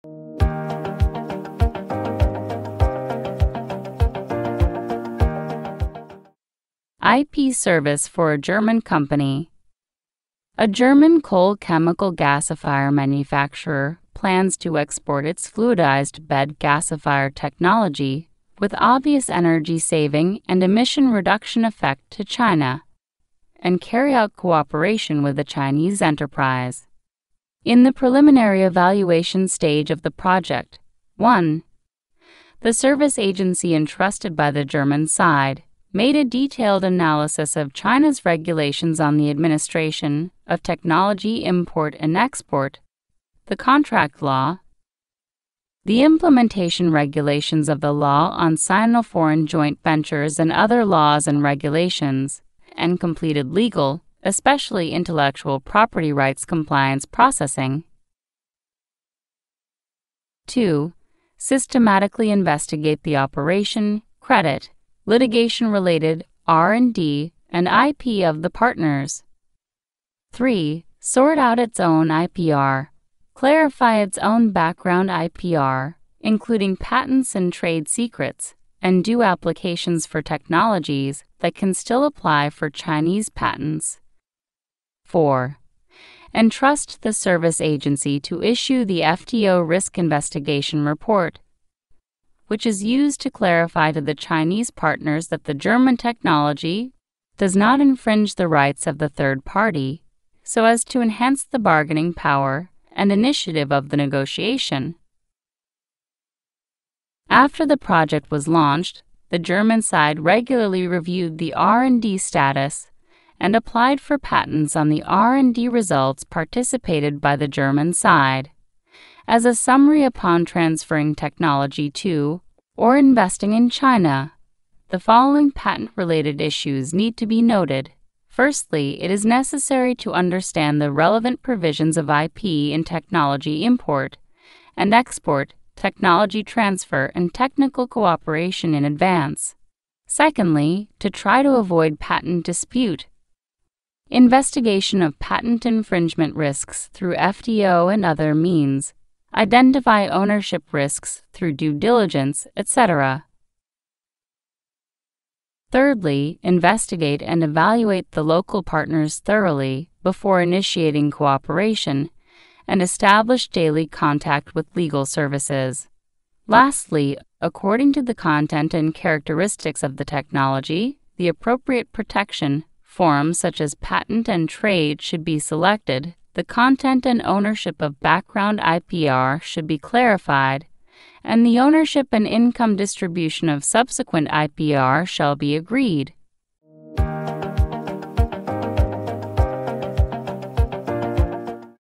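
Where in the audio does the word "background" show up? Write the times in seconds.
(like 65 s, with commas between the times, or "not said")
74 s, 177 s.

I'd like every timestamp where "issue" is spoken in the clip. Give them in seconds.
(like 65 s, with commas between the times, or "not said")
88 s, 126 s.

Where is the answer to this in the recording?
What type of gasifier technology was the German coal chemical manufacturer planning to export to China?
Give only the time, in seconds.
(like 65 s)
15 s.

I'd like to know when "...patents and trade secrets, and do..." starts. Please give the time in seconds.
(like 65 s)
76 s.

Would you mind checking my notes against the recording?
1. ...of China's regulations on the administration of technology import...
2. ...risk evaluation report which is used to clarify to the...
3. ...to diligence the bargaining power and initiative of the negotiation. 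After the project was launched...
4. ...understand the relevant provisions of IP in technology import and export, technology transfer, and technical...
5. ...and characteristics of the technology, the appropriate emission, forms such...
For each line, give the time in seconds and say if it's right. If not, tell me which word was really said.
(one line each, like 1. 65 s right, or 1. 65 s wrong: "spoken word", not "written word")
1. 37 s right
2. 89 s wrong: "investigation", not "evaluation"
3. 100 s wrong: "enhance", not "diligence"
4. 130 s right
5. 168 s wrong: "protection", not "emission".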